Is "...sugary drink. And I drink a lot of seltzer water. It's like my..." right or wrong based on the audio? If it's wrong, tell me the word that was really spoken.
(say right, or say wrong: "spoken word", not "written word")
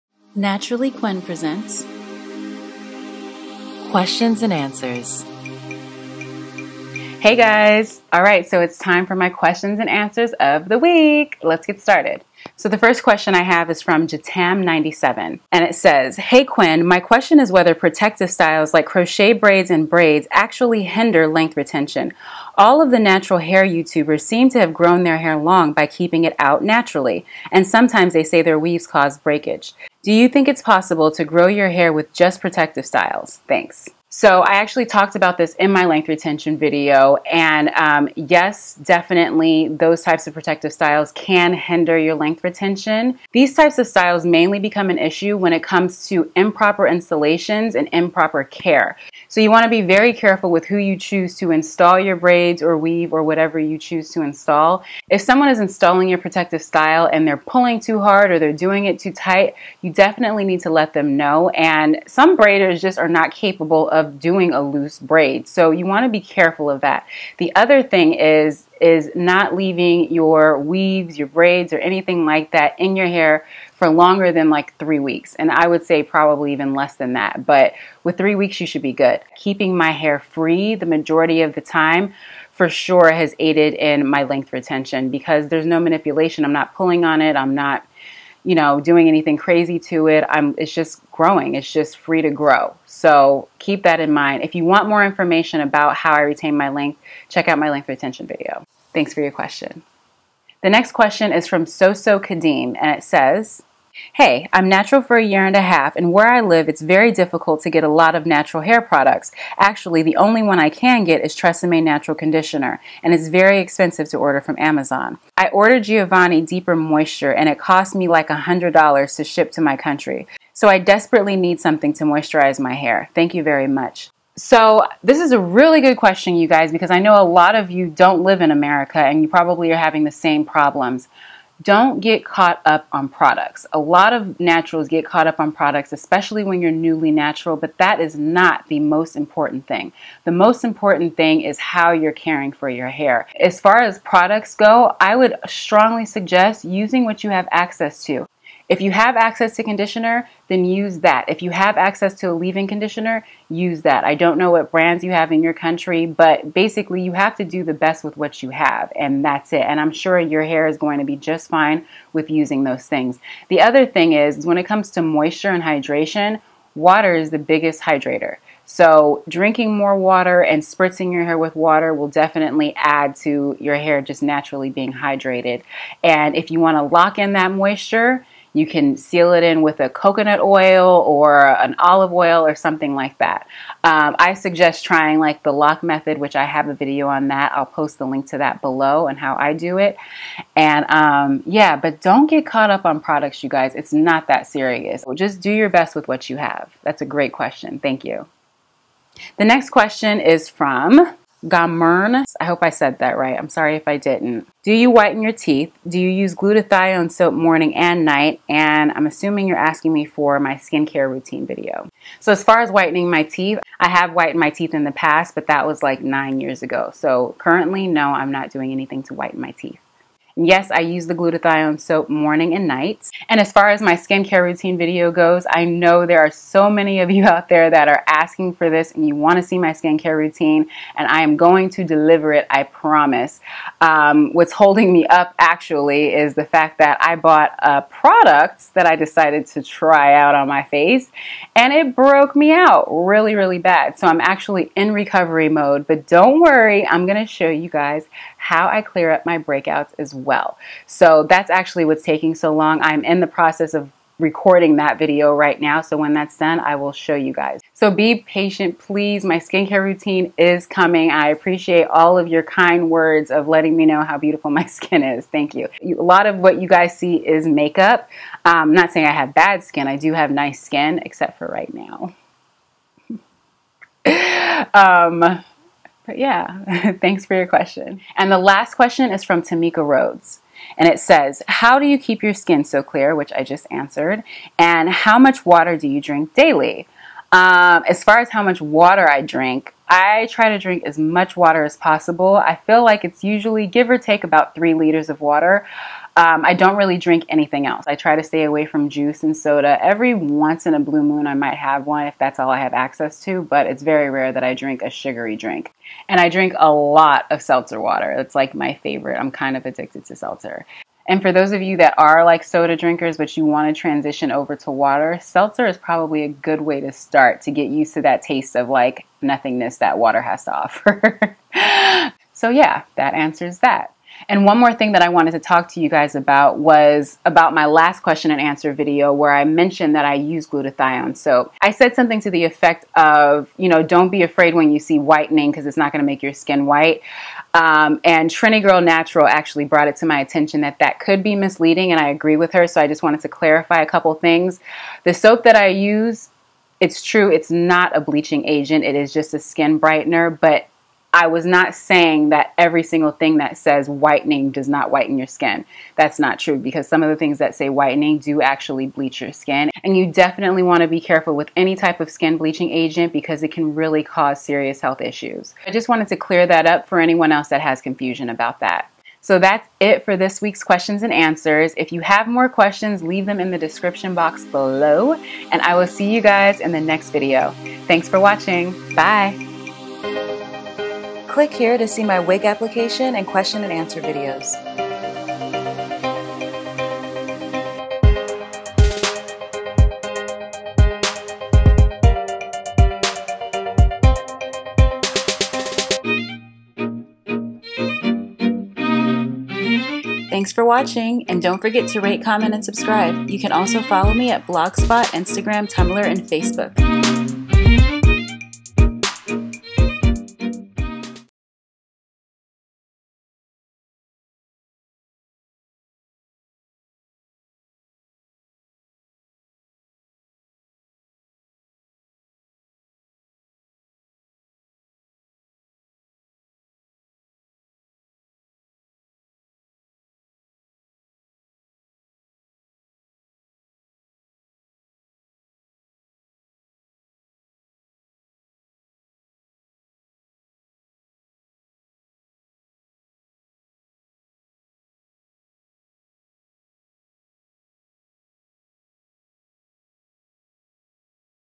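right.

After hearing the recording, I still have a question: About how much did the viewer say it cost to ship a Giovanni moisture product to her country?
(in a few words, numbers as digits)
$100.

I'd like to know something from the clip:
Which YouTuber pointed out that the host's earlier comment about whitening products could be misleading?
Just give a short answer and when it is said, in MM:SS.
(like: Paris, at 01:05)
Trini Girl Natural, at 05:38.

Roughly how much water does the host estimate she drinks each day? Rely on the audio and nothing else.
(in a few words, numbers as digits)
3 liters.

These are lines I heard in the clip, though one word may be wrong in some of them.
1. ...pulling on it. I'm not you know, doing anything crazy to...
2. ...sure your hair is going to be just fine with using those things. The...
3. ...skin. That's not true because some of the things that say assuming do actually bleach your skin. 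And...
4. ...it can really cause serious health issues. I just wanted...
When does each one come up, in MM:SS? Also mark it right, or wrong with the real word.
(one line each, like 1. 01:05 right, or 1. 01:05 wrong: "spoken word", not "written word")
1. 01:26 right
2. 02:39 right
3. 05:55 wrong: "whitening", not "assuming"
4. 06:03 right.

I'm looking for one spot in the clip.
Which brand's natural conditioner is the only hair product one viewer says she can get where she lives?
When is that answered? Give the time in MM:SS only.
01:51.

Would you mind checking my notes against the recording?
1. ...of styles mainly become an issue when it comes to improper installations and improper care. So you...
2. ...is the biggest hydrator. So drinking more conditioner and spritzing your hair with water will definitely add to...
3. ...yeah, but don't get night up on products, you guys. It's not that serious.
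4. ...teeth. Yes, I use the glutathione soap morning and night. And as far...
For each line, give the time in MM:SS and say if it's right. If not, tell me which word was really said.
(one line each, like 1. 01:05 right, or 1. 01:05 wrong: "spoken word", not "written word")
1. 00:43 right
2. 02:47 wrong: "water", not "conditioner"
3. 03:11 wrong: "caught", not "night"
4. 03:39 right.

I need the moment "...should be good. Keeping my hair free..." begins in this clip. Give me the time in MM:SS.
01:18.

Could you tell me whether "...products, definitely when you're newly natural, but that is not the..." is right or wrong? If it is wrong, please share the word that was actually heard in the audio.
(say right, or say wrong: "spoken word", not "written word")
wrong: "especially", not "definitely".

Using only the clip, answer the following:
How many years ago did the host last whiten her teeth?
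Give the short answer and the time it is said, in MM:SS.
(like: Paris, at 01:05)
9 years, at 03:36.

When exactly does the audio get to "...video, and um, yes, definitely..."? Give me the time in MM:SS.
00:36.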